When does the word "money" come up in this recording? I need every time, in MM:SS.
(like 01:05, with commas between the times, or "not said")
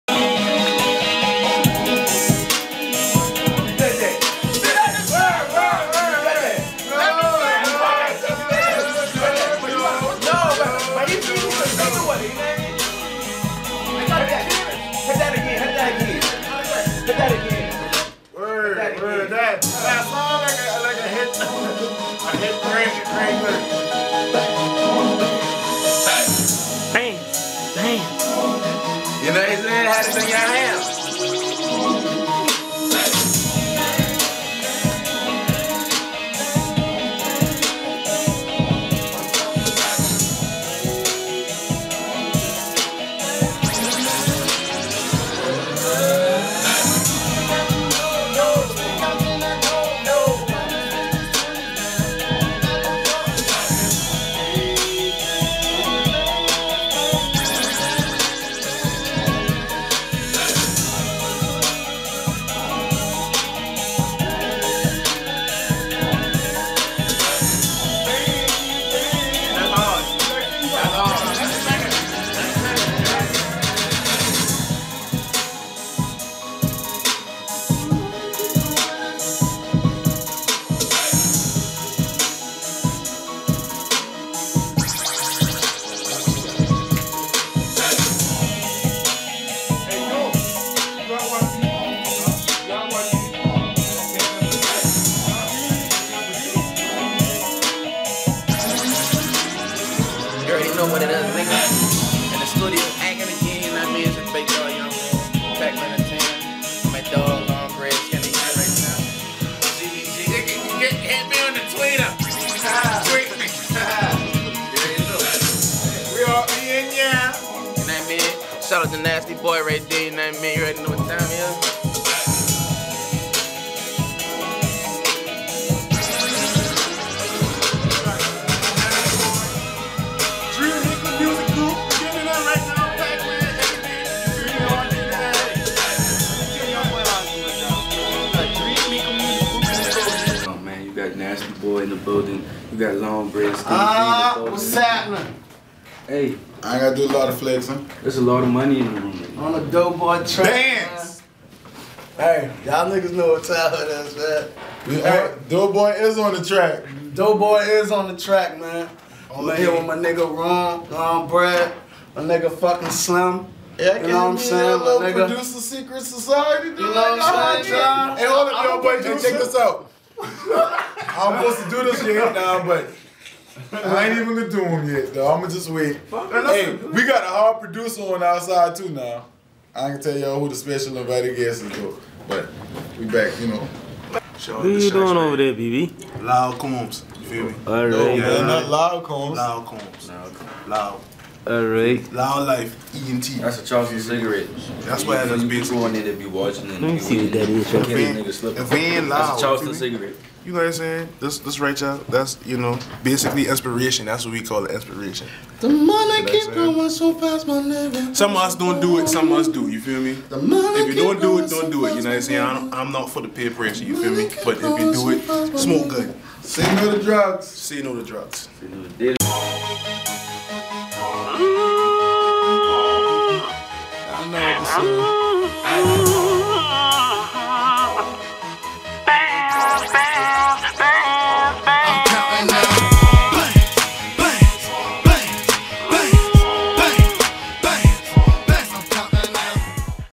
02:28, 03:25, 03:30.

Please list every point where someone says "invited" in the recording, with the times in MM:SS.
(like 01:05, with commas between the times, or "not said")
03:00.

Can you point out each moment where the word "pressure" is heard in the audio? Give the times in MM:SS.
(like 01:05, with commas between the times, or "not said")
03:33.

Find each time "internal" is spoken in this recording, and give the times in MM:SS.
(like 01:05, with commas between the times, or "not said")
not said.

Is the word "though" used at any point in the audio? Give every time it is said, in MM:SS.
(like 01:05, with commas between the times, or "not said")
02:55, 03:01.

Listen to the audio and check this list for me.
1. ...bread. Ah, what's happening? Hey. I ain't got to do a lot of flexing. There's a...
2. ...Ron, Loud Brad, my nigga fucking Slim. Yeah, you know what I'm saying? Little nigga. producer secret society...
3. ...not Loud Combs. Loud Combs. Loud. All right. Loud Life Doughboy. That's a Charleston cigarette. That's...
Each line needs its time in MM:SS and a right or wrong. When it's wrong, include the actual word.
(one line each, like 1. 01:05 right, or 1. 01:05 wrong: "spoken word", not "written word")
1. 02:23 right
2. 02:40 wrong: "Ron", not "Loud"
3. 03:08 wrong: "ENT", not "Doughboy".